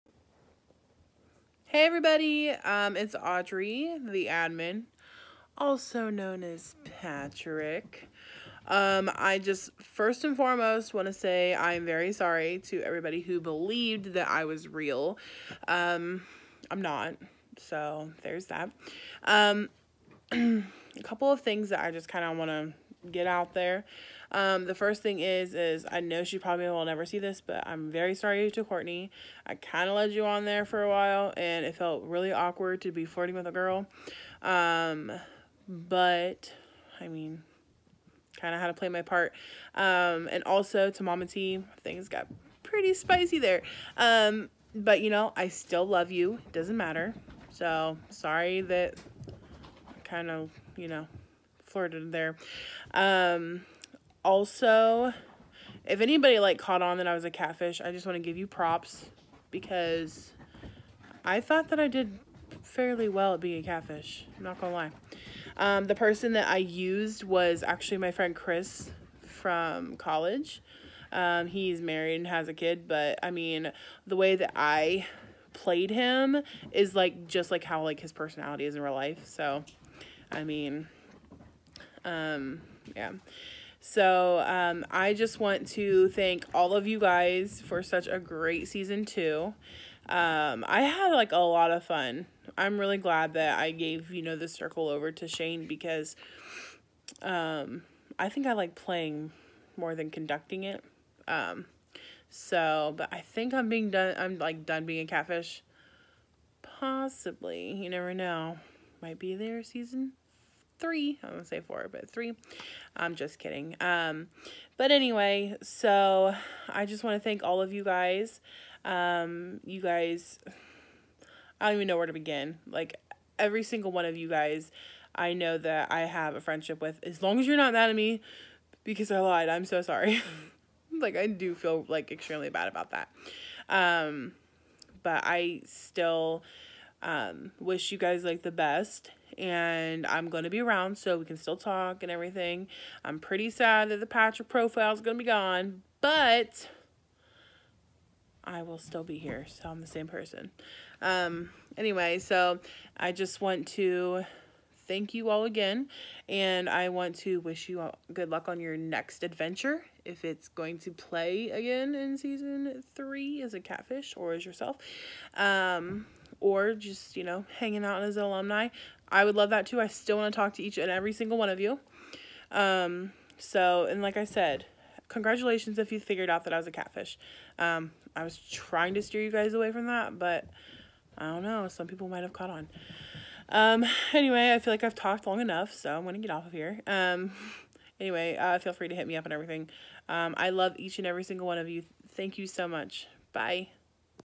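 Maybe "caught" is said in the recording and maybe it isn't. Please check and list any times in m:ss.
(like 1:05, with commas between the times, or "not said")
0:56, 3:02.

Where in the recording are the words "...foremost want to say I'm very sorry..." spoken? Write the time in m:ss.
0:10.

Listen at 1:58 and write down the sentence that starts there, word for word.
Um, you guys, I don't even know where to begin.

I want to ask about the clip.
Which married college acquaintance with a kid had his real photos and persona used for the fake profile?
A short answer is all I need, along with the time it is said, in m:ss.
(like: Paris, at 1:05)
Chris, at 1:08.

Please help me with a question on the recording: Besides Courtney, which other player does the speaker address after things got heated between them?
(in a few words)
Mama T.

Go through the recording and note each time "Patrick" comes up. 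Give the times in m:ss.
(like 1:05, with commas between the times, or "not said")
0:06, 2:24.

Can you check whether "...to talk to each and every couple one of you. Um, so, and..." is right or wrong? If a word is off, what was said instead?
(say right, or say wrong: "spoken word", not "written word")
wrong: "single", not "couple".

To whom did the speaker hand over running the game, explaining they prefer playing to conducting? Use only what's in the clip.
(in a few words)
Shane.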